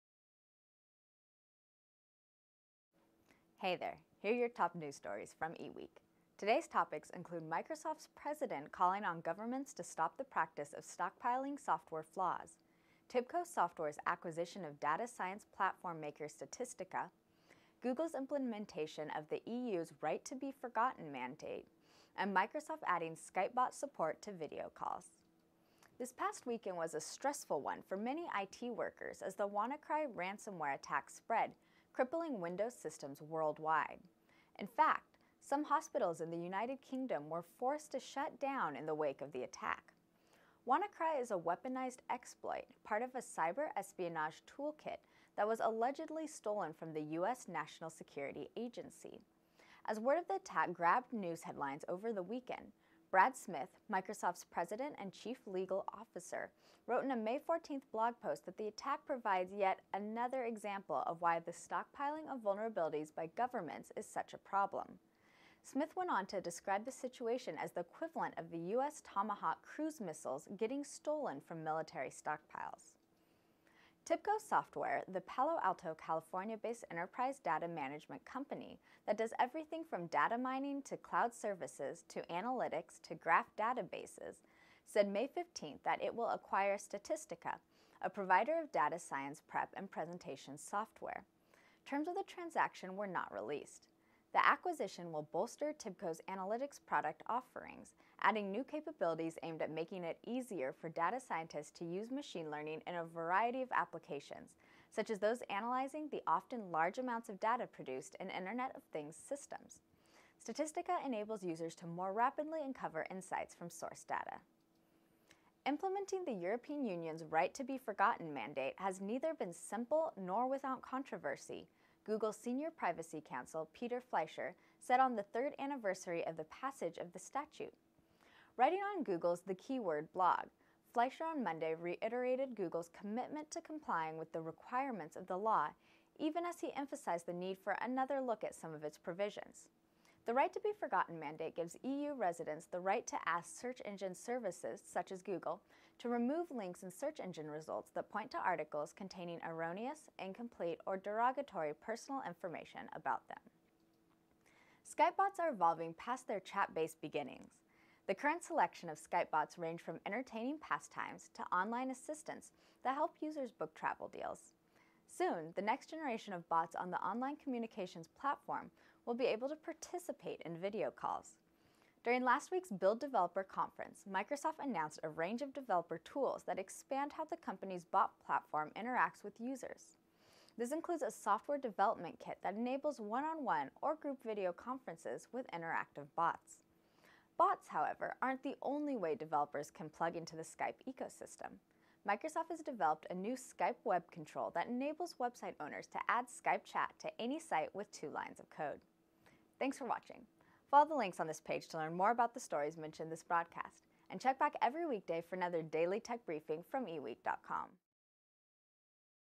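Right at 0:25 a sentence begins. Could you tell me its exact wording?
This past weekend was a stressful one for many IT workers as the WannaCry ransomware attack spread crippling Windows systems worldwide.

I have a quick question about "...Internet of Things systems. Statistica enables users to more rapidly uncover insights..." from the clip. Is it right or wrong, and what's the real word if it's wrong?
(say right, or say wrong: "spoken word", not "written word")
right.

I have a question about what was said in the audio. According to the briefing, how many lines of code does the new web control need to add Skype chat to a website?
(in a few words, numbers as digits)
2.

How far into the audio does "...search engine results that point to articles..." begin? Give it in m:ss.
2:26.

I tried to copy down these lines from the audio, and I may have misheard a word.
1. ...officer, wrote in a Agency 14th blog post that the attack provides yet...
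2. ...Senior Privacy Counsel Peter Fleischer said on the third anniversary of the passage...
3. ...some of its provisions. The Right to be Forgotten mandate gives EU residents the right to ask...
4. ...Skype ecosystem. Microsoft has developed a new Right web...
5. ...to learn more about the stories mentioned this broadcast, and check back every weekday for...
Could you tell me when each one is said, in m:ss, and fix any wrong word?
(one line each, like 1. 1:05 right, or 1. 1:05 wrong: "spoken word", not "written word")
1. 0:55 wrong: "May", not "Agency"
2. 2:02 right
3. 2:18 right
4. 3:10 wrong: "Skype", not "Right"
5. 3:21 right.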